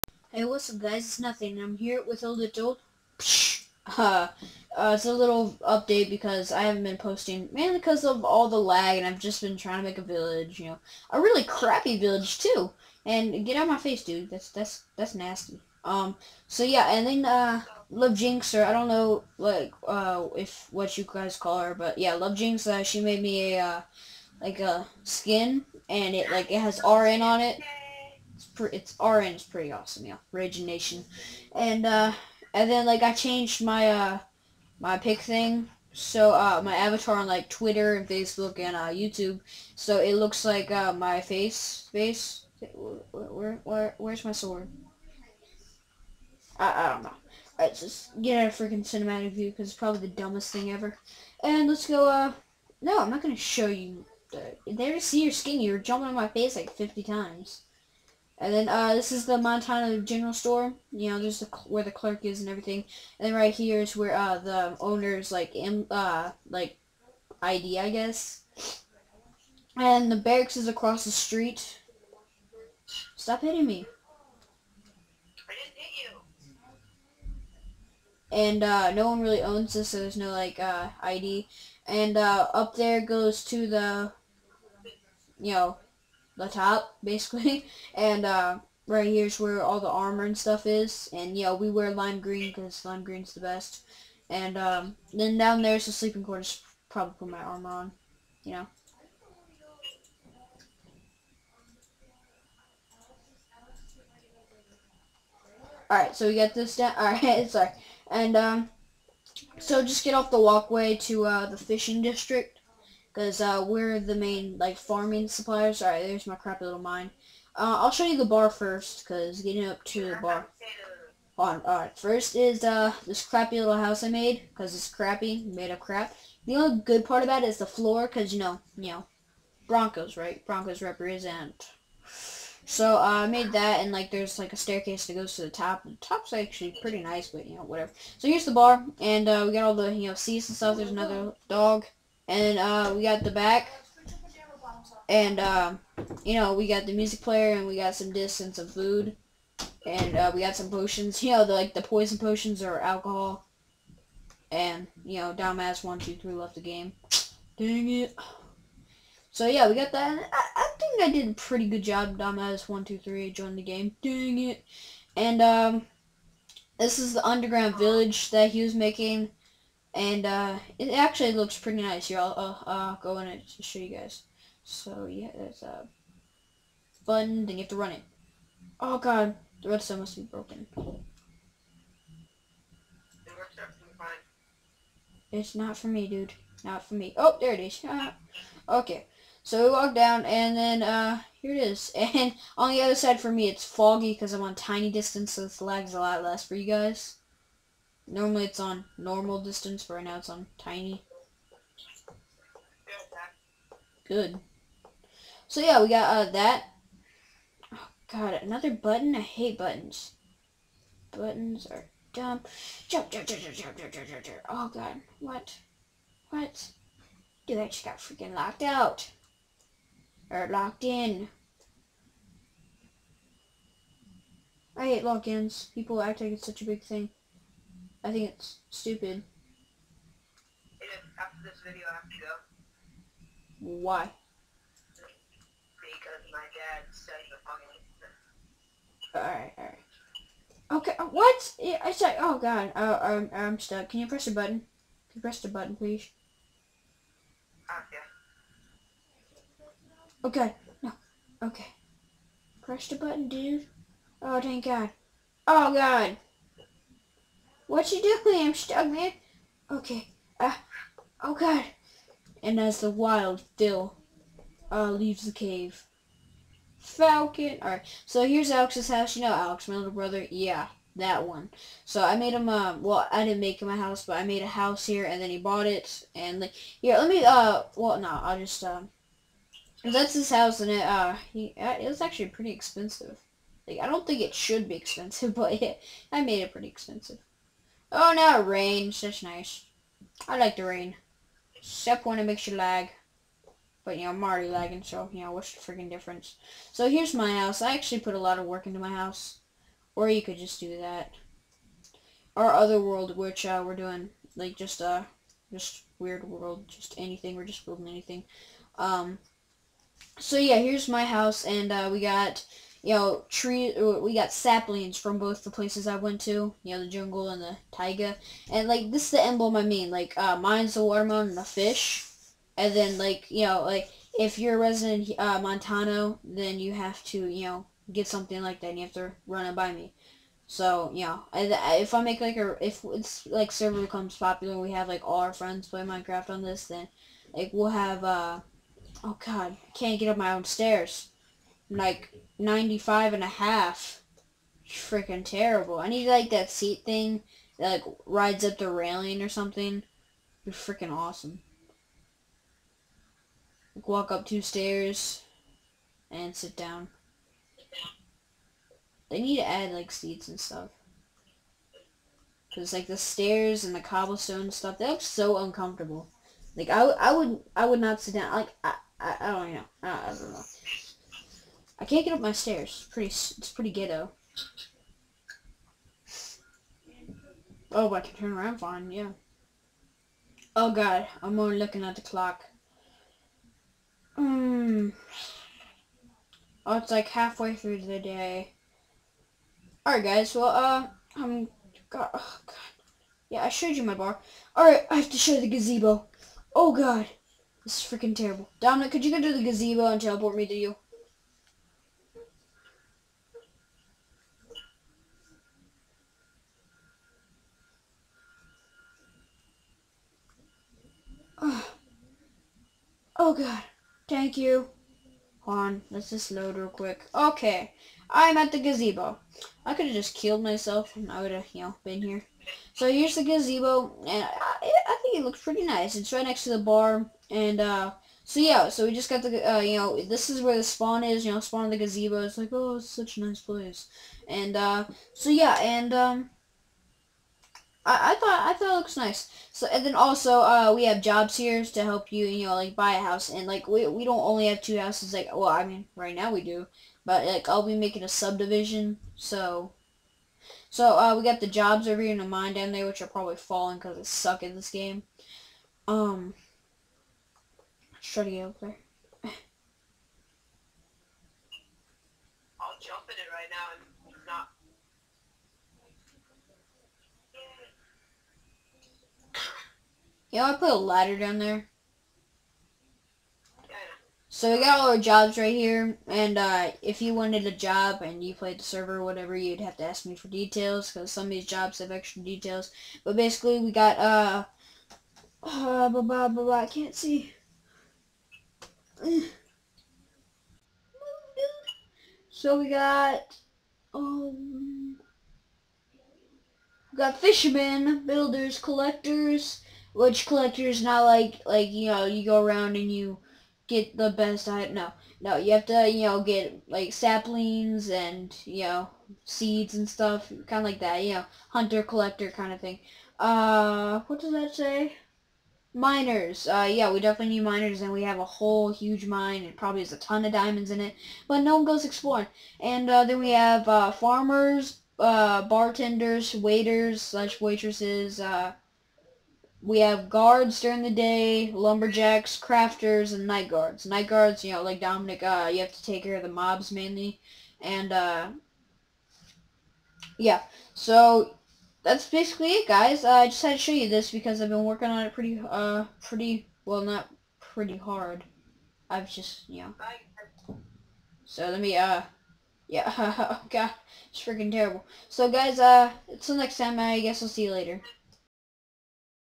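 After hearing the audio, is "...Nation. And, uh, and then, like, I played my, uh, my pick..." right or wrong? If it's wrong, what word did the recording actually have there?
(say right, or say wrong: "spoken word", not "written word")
wrong: "changed", not "played".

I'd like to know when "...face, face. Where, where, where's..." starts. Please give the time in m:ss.
0:41.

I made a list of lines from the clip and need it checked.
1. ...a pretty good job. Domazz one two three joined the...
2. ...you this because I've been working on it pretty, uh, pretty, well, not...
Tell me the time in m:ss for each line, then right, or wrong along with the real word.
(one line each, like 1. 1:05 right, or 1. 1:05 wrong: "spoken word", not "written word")
1. 2:41 right
2. 9:03 right.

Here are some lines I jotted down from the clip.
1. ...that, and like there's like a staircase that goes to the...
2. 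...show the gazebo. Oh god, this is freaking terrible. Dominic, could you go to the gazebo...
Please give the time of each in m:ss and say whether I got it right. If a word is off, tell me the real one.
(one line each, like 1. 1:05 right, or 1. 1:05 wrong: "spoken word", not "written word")
1. 2:13 right
2. 6:35 right.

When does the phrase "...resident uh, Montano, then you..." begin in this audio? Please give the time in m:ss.
5:24.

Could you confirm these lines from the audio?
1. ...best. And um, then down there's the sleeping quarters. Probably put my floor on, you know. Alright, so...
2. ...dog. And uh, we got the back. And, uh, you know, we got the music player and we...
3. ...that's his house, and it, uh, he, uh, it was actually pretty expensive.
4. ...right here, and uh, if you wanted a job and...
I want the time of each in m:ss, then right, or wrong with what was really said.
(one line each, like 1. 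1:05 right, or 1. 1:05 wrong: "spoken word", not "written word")
1. 1:33 wrong: "armor", not "floor"
2. 2:21 right
3. 4:39 right
4. 7:55 right.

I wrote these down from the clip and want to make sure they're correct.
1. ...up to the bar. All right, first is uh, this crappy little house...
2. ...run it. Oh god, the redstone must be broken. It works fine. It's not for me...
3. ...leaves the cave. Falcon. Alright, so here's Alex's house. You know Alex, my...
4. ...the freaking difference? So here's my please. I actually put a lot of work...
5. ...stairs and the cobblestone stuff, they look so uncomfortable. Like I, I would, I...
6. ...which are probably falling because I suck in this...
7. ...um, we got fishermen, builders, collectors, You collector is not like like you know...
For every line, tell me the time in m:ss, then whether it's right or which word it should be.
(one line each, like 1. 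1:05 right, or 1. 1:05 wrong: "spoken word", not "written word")
1. 1:59 right
2. 2:57 right
3. 4:24 right
4. 4:55 wrong: "house", not "please"
5. 6:02 right
6. 7:32 right
7. 8:13 wrong: "Lich", not "You".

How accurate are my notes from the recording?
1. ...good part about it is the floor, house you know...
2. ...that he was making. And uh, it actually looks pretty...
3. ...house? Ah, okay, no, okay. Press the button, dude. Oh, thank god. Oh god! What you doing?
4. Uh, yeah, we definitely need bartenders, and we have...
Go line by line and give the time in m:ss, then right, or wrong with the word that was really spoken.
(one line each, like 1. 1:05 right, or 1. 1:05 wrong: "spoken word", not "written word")
1. 2:06 wrong: "cause", not "house"
2. 2:48 right
3. 4:05 wrong: "please", not "house"
4. 8:36 wrong: "miners", not "bartenders".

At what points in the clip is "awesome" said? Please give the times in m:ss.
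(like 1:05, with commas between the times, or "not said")
0:29, 5:50.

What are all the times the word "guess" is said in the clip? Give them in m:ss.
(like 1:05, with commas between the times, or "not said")
1:07, 9:16.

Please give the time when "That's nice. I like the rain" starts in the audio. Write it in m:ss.
4:49.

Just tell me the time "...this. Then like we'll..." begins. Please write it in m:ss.
5:36.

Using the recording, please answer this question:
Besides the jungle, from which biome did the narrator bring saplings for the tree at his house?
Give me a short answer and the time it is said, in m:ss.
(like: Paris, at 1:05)
Taiga, at 5:17.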